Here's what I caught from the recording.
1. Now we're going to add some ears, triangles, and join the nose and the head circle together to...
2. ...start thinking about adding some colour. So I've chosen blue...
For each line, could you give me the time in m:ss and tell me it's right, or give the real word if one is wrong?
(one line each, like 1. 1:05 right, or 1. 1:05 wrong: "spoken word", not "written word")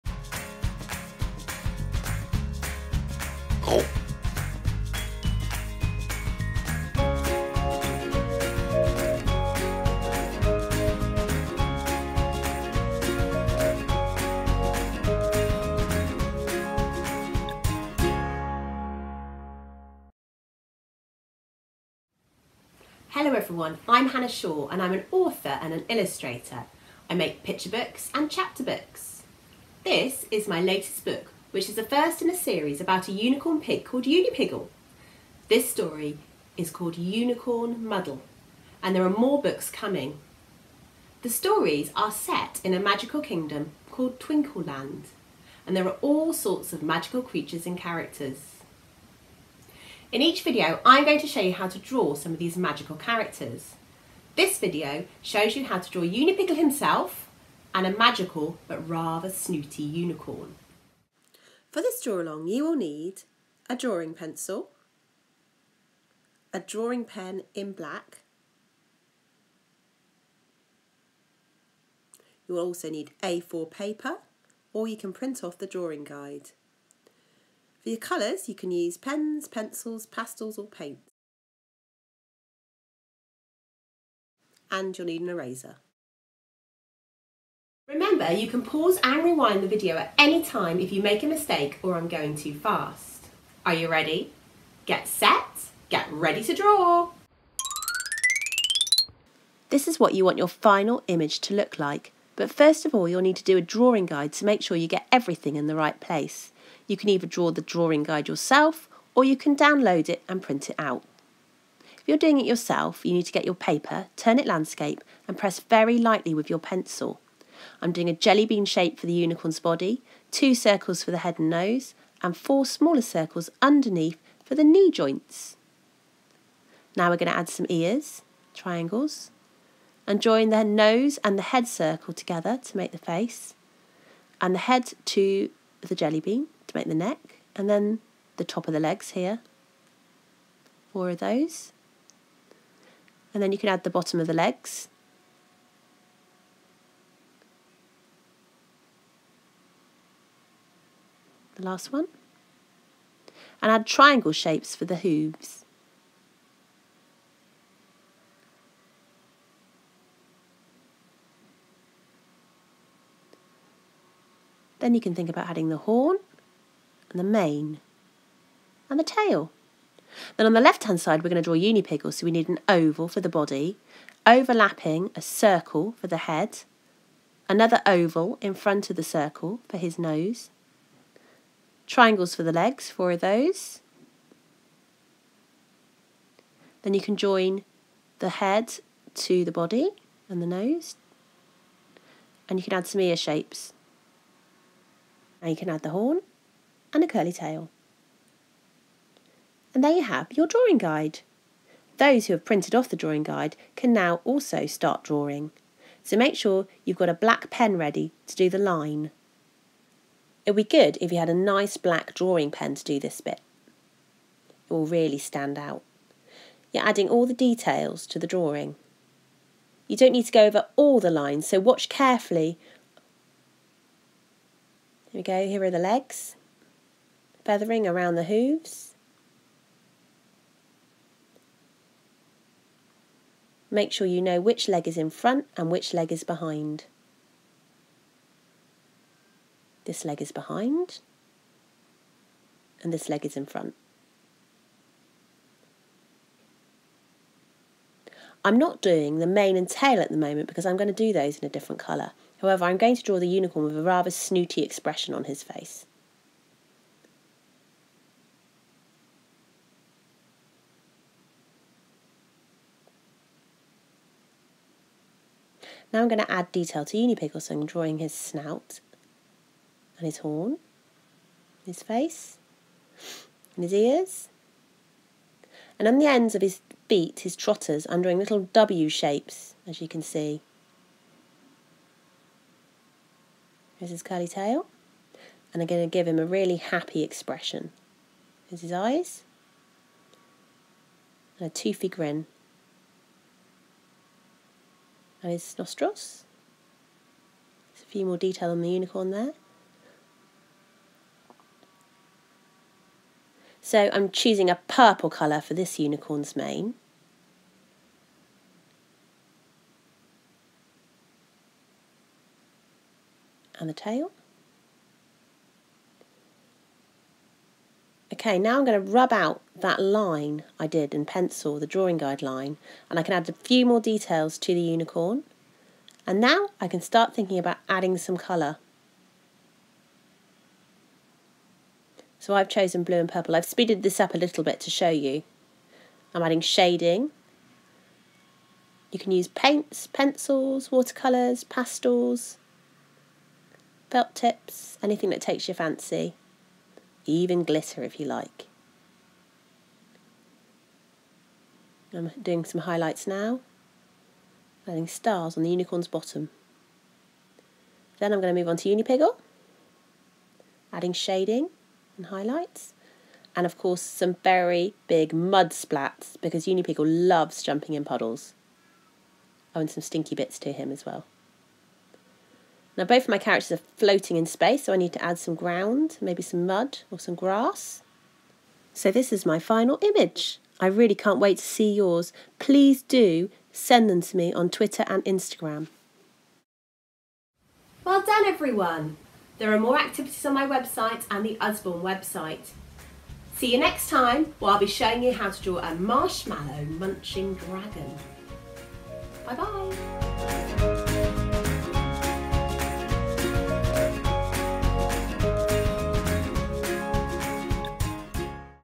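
1. 2:06 right
2. 5:26 right.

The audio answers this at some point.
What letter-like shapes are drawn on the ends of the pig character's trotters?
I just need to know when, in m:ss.
4:38.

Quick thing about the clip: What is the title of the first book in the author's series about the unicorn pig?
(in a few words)
Unicorn Muddle.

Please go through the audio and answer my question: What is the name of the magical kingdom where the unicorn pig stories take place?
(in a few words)
Twinkleland.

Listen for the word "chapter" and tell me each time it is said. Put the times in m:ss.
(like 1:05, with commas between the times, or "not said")
0:28.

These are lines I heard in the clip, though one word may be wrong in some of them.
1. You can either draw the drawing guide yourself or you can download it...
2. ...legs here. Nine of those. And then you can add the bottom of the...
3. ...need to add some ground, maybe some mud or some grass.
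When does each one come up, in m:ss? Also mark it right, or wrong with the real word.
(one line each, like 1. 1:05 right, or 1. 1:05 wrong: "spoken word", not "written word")
1. 1:46 right
2. 2:18 wrong: "Four", not "Nine"
3. 6:14 right.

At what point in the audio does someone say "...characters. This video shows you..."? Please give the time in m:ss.
0:52.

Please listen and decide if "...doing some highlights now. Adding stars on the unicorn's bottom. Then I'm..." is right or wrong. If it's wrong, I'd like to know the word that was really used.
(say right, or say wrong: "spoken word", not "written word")
right.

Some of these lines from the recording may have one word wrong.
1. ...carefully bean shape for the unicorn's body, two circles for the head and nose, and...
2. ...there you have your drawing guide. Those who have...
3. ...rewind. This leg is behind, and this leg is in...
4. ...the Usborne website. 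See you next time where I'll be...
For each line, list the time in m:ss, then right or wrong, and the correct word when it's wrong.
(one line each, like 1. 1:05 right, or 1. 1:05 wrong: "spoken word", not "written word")
1. 1:58 wrong: "jelly", not "carefully"
2. 3:19 right
3. 3:56 wrong: "behind", not "rewind"
4. 6:31 right.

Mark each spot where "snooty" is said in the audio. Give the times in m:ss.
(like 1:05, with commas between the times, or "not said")
0:59, 4:14.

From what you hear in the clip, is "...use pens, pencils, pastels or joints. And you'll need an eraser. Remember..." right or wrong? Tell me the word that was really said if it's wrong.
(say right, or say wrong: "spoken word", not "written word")
wrong: "paints", not "joints".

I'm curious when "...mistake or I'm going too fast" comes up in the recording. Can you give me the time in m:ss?
1:31.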